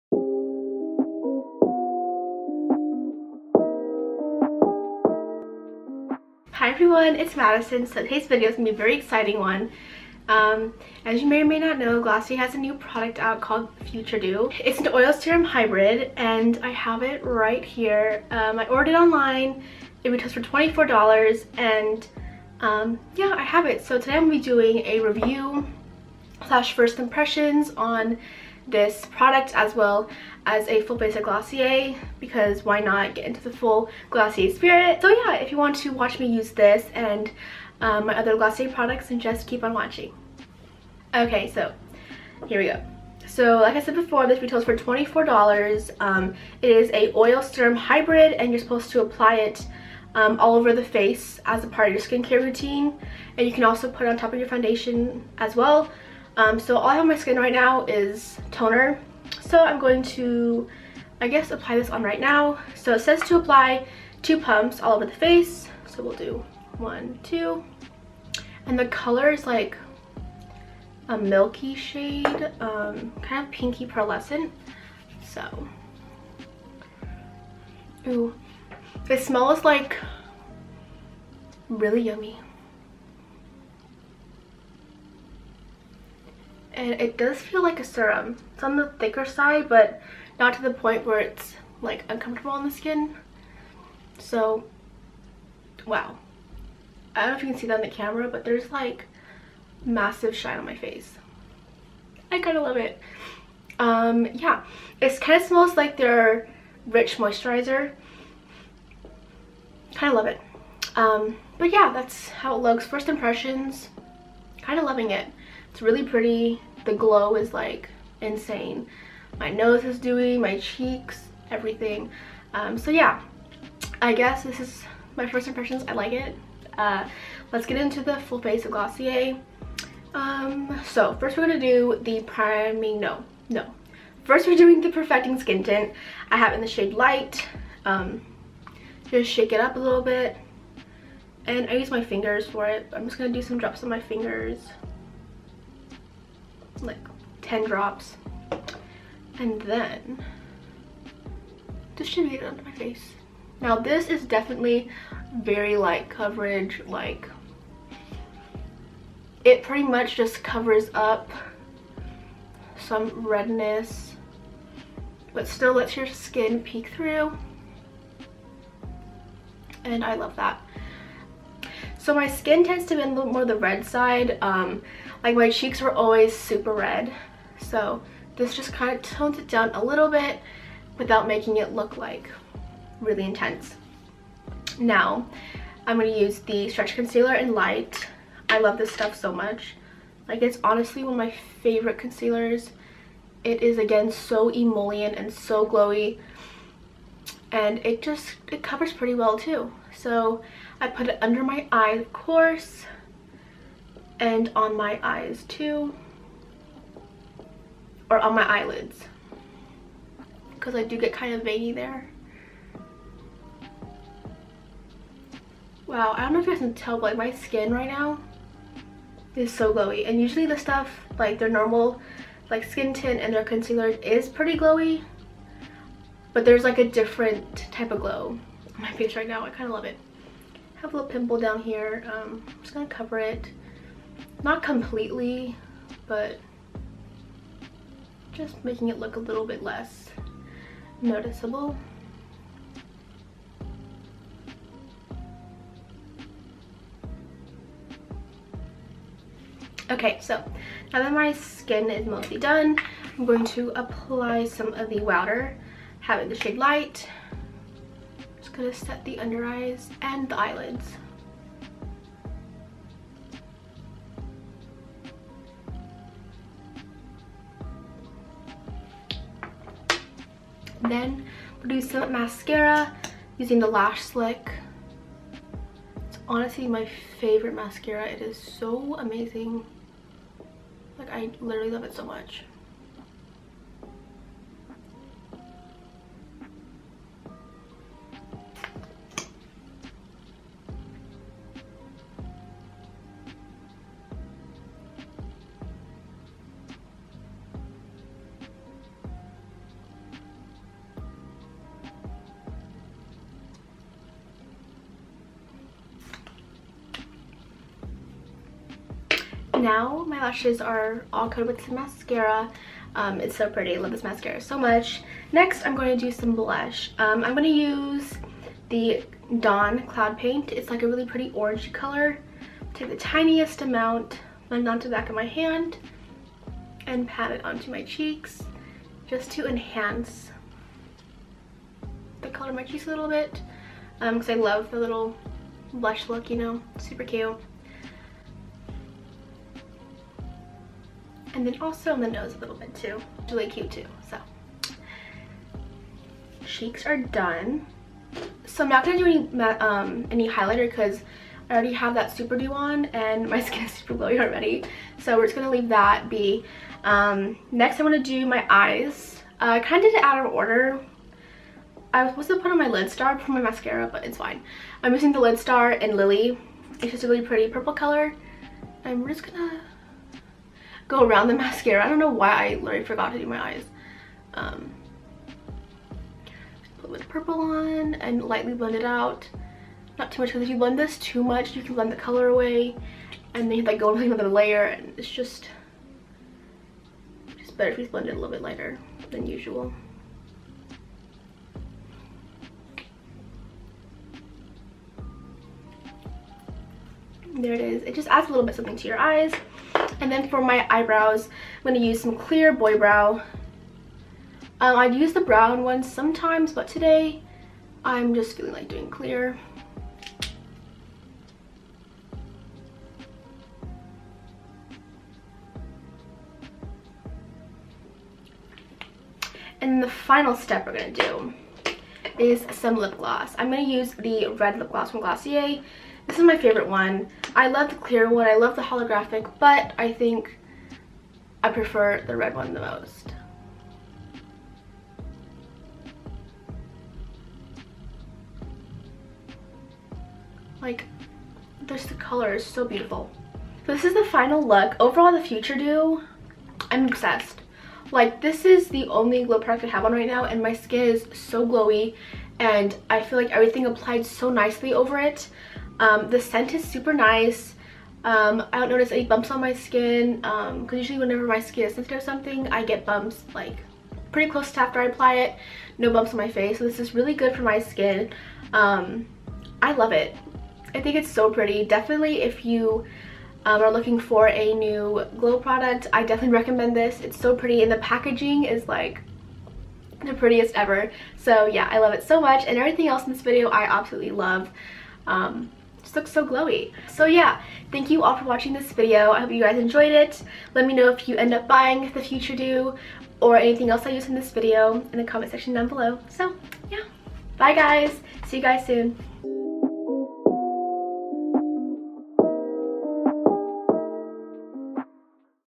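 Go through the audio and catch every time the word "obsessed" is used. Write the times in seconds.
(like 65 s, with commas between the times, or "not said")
446 s.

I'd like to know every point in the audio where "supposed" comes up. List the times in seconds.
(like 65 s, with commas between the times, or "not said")
48 s, 362 s.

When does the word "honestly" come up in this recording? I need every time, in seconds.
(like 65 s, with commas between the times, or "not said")
190 s, 276 s.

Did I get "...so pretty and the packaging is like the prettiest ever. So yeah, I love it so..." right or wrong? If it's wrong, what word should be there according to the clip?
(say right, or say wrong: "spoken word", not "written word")
right.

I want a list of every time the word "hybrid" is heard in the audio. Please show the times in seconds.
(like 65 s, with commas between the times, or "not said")
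15 s, 47 s.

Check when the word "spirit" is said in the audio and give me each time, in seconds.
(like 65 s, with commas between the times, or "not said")
34 s.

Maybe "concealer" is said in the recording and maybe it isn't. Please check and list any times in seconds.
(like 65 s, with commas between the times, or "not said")
186 s, 191 s, 223 s.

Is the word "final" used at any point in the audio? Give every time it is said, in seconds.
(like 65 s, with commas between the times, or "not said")
419 s, 444 s.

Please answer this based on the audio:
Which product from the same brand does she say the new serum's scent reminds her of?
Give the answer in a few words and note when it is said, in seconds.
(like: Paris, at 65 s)
rich moisturizer, at 106 s.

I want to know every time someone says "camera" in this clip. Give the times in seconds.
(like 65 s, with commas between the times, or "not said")
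97 s.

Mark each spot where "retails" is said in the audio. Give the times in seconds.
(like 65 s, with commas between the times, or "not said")
20 s, 44 s.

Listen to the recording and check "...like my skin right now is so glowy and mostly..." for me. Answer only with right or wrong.
wrong.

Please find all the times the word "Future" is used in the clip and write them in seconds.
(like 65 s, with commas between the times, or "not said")
13 s, 445 s, 492 s.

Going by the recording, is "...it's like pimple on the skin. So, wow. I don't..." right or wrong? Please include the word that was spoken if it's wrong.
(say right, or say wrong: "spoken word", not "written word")
wrong: "uncomfortable", not "pimple".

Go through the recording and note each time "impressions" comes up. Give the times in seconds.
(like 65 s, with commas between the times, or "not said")
26 s, 113 s, 125 s.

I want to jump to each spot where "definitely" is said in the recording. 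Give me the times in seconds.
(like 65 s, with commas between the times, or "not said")
154 s, 471 s, 476 s.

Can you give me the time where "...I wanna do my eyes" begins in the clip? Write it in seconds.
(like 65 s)
357 s.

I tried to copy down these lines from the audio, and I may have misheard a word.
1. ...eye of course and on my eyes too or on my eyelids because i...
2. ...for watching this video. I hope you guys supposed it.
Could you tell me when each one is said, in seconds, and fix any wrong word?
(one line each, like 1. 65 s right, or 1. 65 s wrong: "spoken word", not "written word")
1. 201 s right
2. 488 s wrong: "enjoyed", not "supposed".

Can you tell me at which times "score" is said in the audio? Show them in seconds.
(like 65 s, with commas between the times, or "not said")
not said.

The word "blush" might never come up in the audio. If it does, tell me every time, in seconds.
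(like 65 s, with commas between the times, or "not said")
316 s, 335 s.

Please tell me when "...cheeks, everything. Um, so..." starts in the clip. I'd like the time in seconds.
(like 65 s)
120 s.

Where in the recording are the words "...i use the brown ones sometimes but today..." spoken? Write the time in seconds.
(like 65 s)
404 s.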